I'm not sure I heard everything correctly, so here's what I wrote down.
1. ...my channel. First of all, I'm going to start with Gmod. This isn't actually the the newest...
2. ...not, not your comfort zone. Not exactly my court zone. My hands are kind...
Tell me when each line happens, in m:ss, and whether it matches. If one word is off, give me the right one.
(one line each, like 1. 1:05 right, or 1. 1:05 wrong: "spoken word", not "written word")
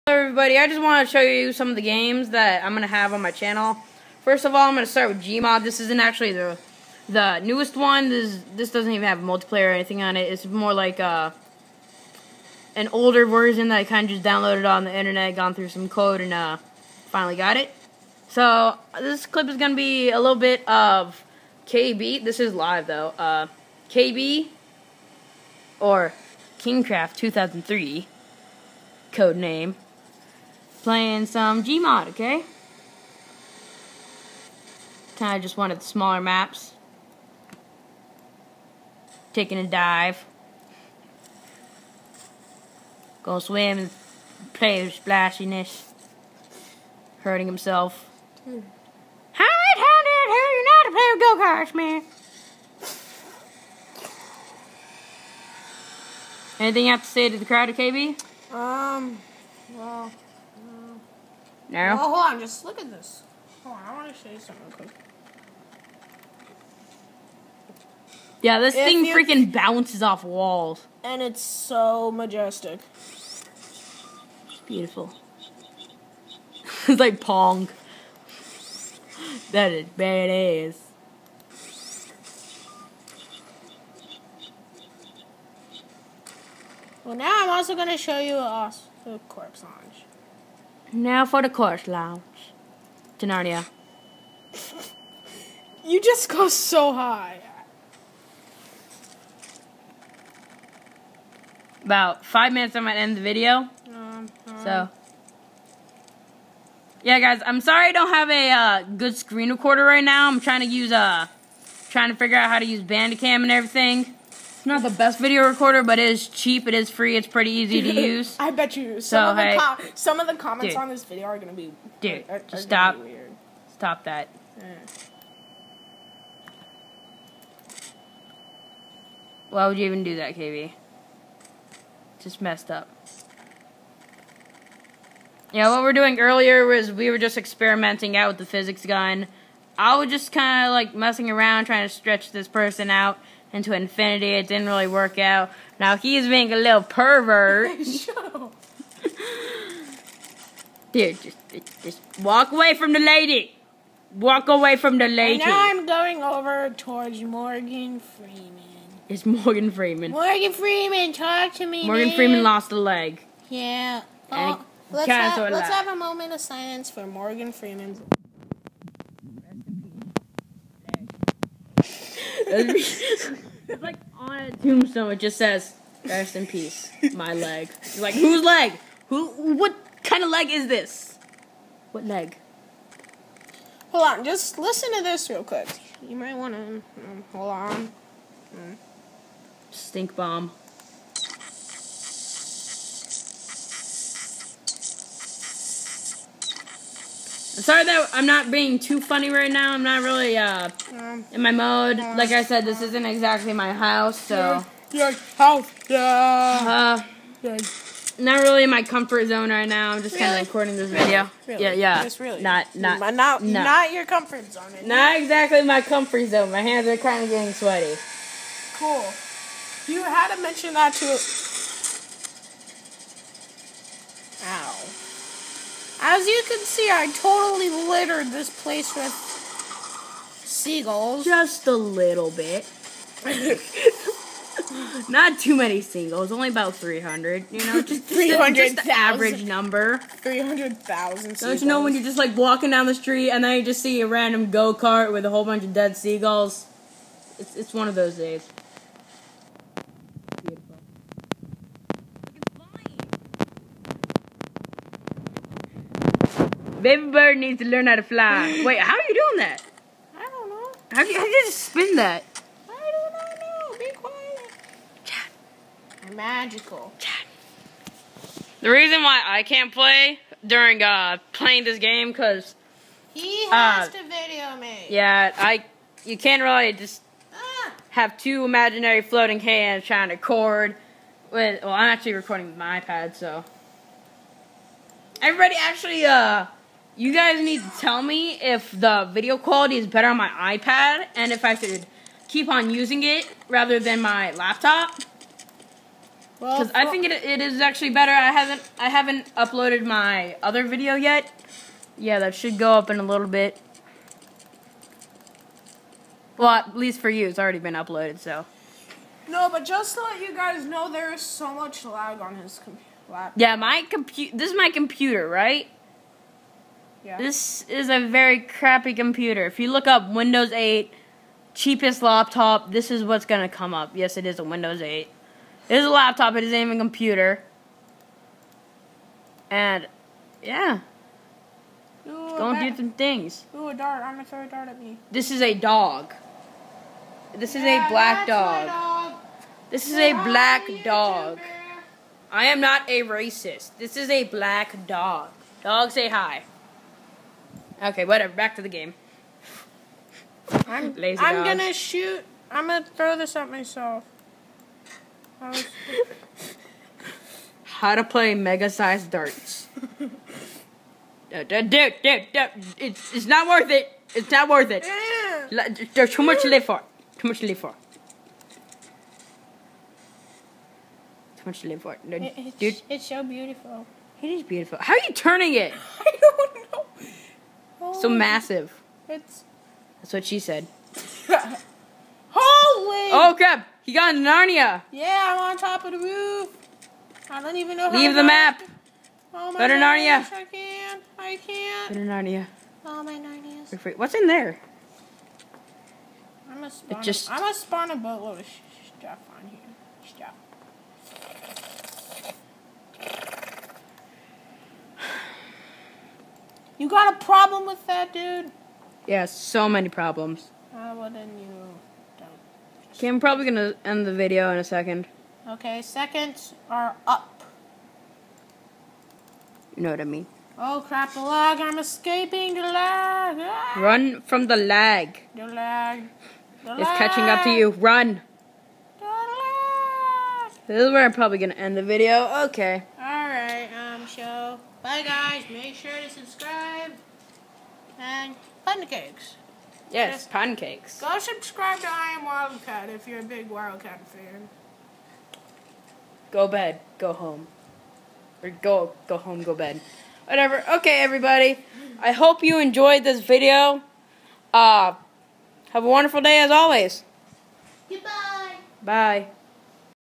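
1. 0:03 right
2. 3:33 wrong: "comfort", not "court".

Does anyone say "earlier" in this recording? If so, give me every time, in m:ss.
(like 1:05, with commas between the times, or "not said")
2:16.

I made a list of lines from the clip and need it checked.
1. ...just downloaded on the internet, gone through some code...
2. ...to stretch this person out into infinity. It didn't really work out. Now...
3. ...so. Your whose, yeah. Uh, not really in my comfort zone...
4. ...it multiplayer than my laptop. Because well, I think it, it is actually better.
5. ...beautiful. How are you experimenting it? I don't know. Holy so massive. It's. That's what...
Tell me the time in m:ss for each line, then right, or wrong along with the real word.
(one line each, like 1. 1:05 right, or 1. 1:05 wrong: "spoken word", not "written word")
1. 0:14 right
2. 2:21 right
3. 3:24 wrong: "house", not "whose"
4. 4:53 wrong: "rather", not "multiplayer"
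5. 6:14 wrong: "turning", not "experimenting".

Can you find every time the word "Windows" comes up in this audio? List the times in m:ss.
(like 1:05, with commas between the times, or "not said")
5:20, 5:24.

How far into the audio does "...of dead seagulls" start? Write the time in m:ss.
4:05.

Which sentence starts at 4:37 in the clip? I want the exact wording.
have two imaginary floating hands trying to record.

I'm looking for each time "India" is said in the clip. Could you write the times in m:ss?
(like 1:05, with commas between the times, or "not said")
not said.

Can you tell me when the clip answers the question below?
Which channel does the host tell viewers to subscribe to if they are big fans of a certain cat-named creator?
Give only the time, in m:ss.
7:21.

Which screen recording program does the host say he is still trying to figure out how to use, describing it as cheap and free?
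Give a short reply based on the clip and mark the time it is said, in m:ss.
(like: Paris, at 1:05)
Bandicam, at 1:52.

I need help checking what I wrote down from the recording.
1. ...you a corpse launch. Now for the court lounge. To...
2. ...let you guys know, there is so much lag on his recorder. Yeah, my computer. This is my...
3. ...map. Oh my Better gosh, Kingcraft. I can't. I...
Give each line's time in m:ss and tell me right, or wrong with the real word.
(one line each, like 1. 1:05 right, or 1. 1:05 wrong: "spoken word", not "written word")
1. 1:28 right
2. 5:10 wrong: "computer", not "recorder"
3. 6:28 wrong: "Narnia", not "Kingcraft".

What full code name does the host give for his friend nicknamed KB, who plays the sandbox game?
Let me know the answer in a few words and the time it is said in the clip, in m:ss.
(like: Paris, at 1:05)
Kingcraft 2003, at 0:26.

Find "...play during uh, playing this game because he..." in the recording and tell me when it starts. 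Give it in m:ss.
4:29.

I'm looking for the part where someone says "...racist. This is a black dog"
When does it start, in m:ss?
5:43.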